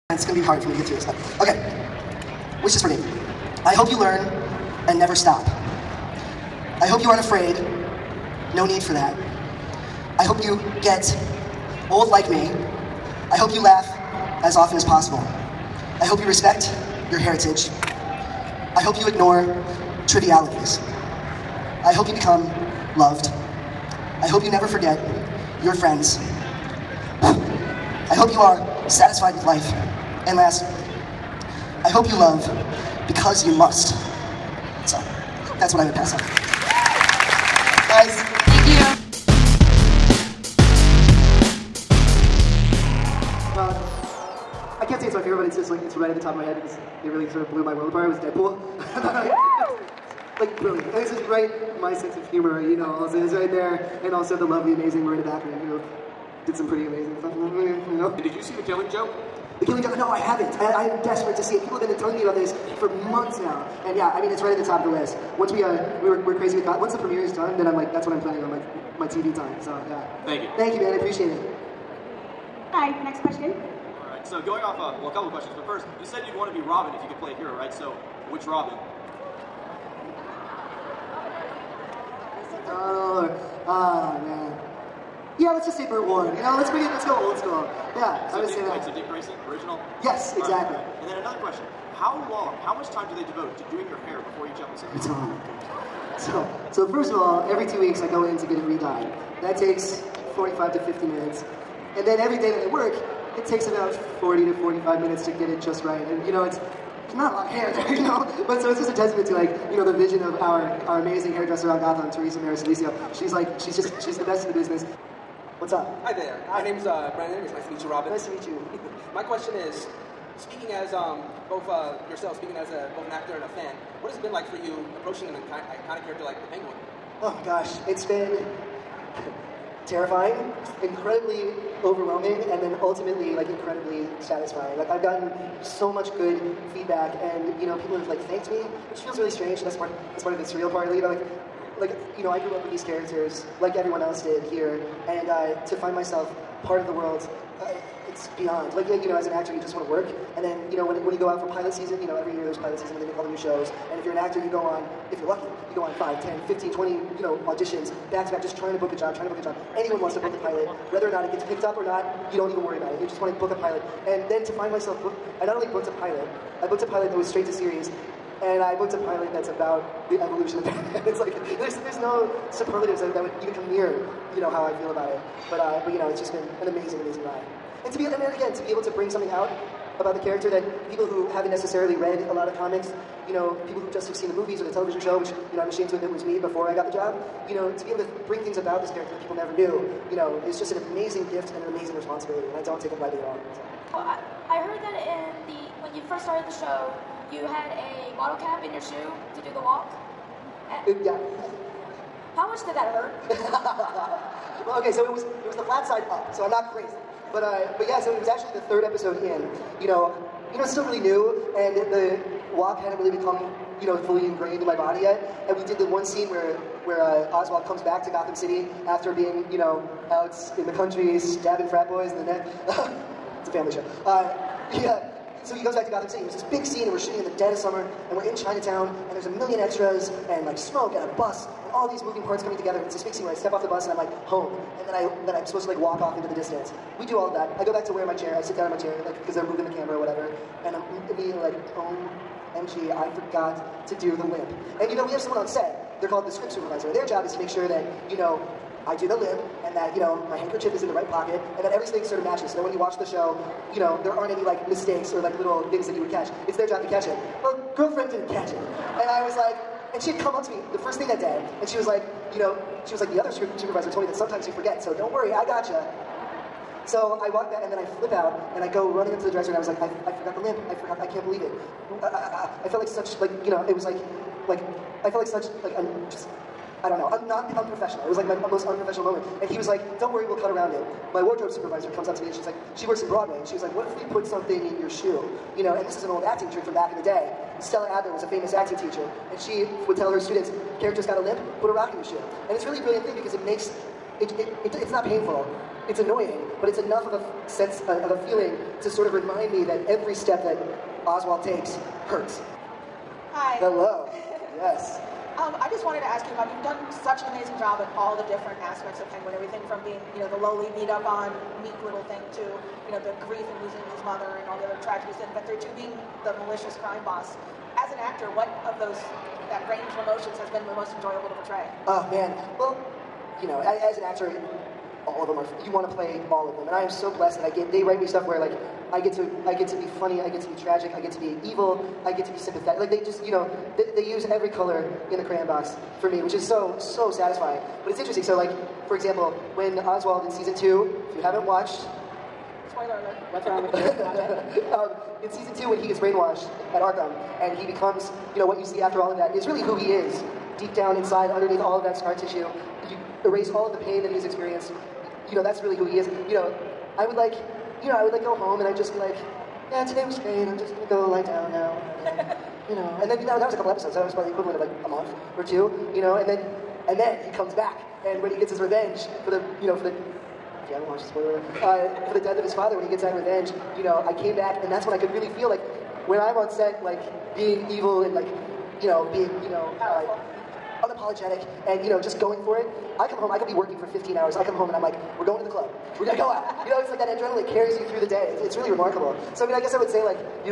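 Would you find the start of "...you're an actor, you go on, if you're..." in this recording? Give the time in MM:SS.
02:34.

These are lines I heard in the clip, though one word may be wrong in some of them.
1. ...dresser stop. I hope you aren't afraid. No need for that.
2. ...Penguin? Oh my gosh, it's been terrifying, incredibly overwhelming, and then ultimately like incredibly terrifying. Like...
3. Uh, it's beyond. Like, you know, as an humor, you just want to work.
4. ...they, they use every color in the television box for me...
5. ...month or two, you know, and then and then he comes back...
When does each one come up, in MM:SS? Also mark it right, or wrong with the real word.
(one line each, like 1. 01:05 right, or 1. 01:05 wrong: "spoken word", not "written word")
1. 00:04 wrong: "never", not "dresser"
2. 02:06 wrong: "satisfying", not "terrifying"
3. 02:27 wrong: "actor", not "humor"
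4. 05:33 wrong: "crayon", not "television"
5. 06:04 right.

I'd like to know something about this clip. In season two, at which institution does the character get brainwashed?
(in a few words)
Arkham.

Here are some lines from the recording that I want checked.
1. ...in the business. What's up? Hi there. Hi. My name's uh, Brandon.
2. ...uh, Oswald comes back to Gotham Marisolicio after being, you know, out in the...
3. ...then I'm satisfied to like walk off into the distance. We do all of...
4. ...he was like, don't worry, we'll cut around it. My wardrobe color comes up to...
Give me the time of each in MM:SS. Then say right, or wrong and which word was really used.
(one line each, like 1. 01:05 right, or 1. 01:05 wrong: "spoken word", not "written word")
1. 01:54 right
2. 03:37 wrong: "City", not "Marisolicio"
3. 03:55 wrong: "supposed", not "satisfied"
4. 04:39 wrong: "supervisor", not "color".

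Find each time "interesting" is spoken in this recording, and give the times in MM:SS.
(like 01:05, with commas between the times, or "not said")
05:37.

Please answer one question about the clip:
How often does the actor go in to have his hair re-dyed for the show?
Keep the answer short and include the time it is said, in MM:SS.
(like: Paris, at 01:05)
Every 2 weeks, at 01:37.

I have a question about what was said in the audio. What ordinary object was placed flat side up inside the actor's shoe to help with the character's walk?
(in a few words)
Bottle cap.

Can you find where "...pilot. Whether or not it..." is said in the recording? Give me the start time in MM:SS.
02:40.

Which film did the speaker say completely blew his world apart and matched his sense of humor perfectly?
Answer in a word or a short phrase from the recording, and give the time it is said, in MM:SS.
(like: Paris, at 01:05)
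Deadpool, at 00:48.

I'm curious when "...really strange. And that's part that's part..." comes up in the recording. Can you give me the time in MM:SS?
02:19.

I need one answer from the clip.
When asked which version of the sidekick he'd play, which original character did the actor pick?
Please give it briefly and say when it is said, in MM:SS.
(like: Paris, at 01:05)
Dick Grayson, at 01:28.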